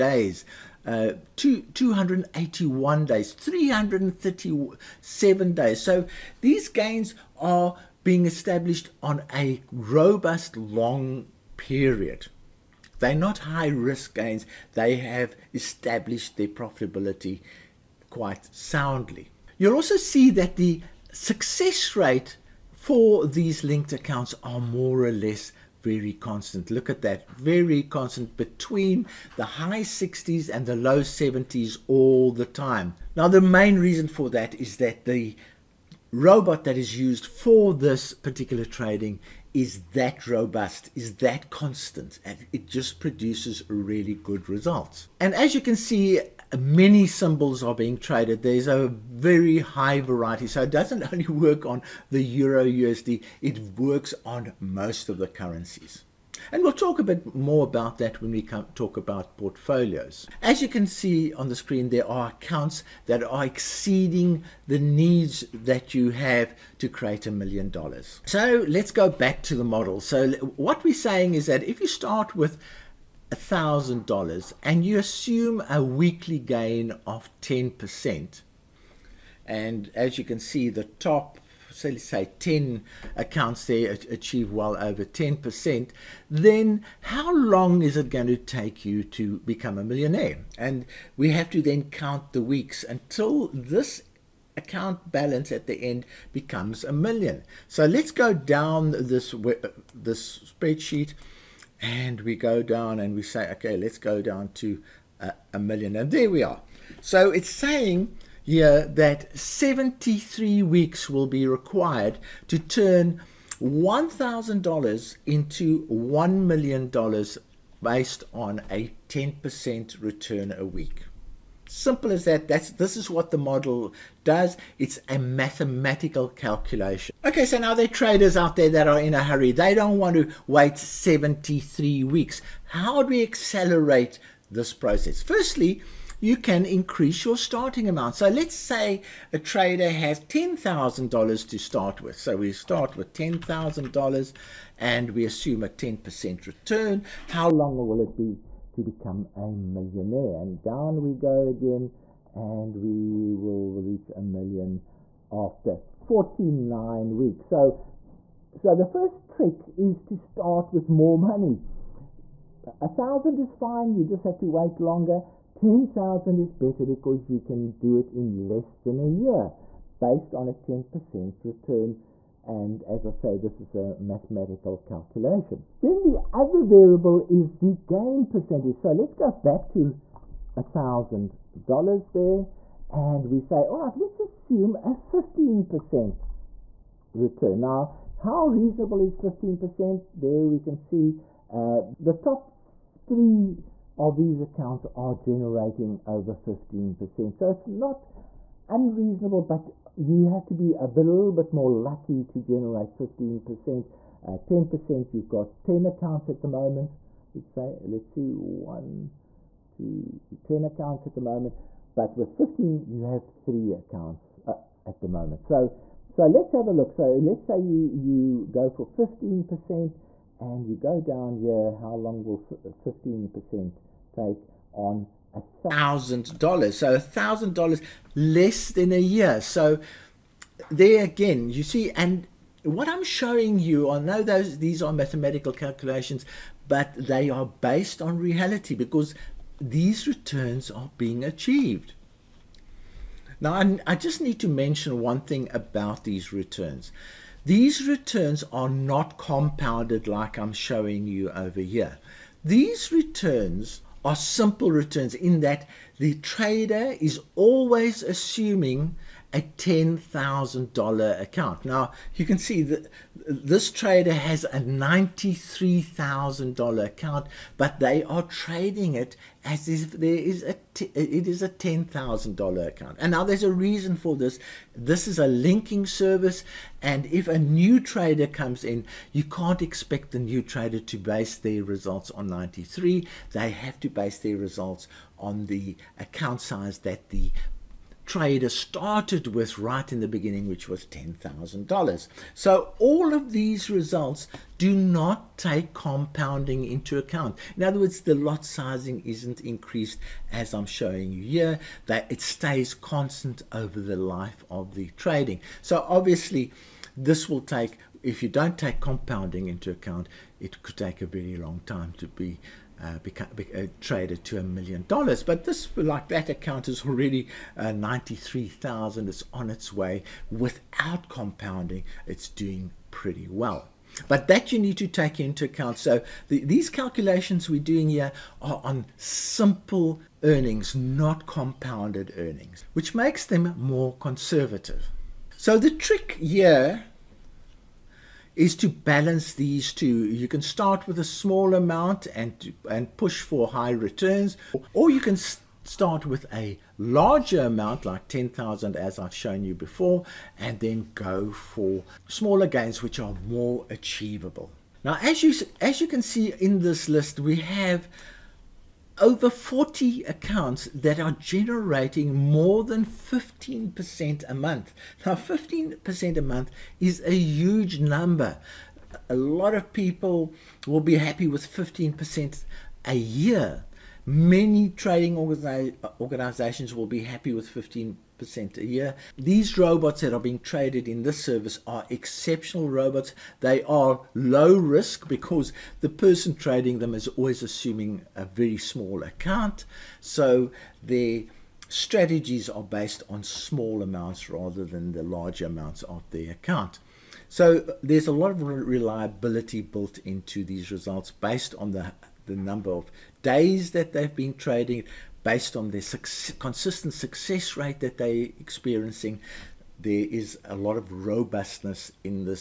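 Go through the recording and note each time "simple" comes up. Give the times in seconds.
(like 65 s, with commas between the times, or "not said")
121 s, 254 s, 328 s.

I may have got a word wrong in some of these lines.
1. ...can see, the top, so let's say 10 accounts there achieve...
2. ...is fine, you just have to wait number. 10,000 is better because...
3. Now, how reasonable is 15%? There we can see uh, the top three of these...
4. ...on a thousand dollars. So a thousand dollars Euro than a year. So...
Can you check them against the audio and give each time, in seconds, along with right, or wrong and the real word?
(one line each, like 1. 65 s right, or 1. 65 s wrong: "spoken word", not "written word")
1. 80 s right
2. 163 s wrong: "longer", not "number"
3. 187 s right
4. 224 s wrong: "Less", not "Euro".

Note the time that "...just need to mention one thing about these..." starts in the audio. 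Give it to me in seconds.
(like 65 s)
243 s.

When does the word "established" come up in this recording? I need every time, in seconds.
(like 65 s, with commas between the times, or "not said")
8 s, 15 s.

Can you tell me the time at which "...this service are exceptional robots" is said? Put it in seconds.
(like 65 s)
381 s.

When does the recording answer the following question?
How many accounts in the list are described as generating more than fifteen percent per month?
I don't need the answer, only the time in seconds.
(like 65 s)
358 s.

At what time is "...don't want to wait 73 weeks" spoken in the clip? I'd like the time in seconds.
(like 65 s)
129 s.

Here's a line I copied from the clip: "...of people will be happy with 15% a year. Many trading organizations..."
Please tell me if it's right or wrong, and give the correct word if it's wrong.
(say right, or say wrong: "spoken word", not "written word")
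right.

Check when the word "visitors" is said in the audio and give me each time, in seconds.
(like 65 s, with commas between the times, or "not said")
not said.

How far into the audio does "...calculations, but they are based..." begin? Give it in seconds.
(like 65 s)
235 s.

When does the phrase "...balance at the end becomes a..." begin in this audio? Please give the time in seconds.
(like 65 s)
95 s.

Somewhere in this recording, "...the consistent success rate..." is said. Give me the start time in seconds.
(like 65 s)
405 s.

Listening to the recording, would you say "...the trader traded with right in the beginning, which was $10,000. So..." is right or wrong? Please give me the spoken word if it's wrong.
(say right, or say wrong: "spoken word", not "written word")
wrong: "started", not "traded".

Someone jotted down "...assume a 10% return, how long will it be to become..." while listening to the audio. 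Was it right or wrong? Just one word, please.
right.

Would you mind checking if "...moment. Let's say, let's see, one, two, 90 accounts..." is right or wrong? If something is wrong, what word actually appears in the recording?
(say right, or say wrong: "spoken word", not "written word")
wrong: "10", not "90".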